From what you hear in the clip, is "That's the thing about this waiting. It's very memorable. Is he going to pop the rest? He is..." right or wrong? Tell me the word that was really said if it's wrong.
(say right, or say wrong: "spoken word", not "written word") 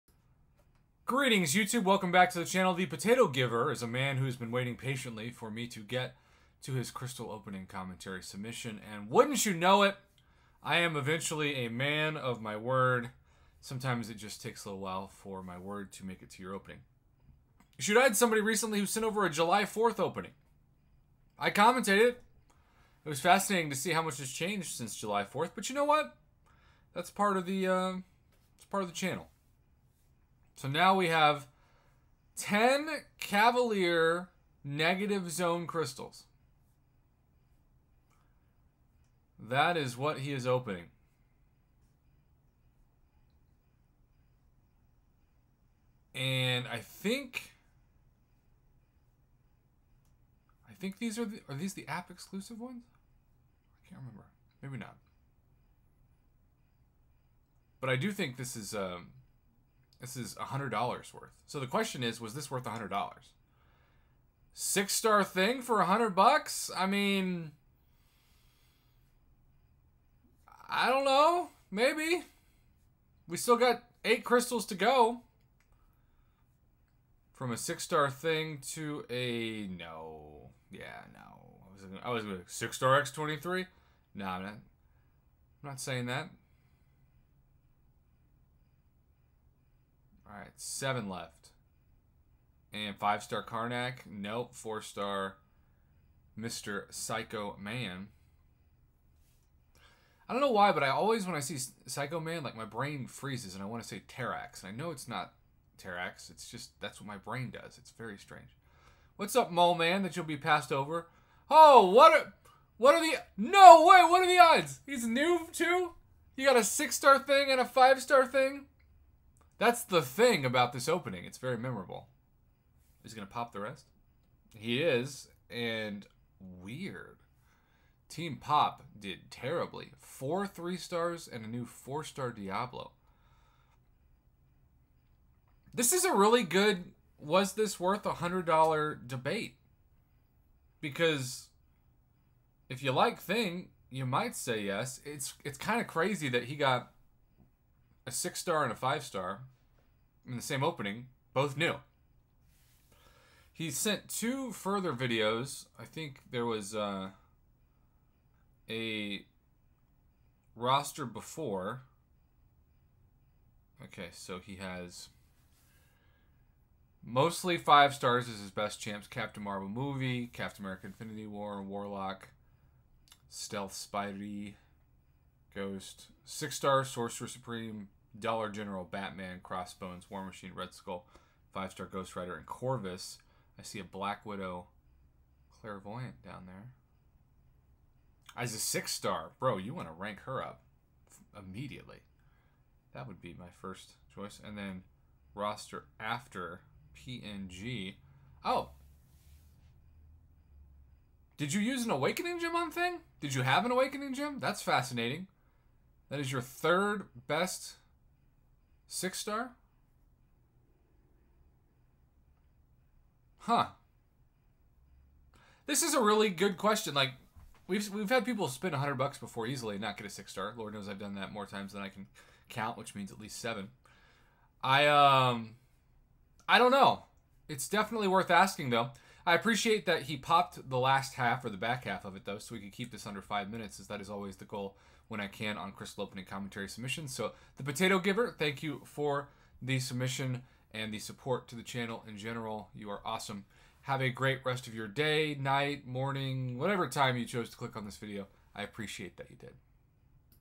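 wrong: "opening", not "waiting".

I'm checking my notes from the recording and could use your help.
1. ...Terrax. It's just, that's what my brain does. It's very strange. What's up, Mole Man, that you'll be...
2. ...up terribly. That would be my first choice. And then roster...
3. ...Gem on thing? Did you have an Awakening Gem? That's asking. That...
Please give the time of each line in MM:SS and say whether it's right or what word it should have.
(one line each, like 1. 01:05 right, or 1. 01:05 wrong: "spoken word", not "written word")
1. 01:45 right
2. 03:10 wrong: "immediately", not "terribly"
3. 03:22 wrong: "fascinating", not "asking".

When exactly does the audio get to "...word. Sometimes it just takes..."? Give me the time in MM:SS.
00:12.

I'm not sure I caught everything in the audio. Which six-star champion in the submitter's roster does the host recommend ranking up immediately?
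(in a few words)
Black Widow Clairvoyant.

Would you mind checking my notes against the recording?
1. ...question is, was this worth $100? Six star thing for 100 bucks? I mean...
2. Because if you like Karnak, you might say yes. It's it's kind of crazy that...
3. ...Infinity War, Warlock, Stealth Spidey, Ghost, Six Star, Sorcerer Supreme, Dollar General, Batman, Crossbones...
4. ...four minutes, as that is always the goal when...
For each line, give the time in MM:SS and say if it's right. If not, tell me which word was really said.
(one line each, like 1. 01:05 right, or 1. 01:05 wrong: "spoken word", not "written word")
1. 01:01 right
2. 02:20 wrong: "Thing", not "Karnak"
3. 02:50 right
4. 03:53 wrong: "five", not "four".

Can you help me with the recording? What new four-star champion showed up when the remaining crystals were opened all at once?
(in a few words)
Diablo.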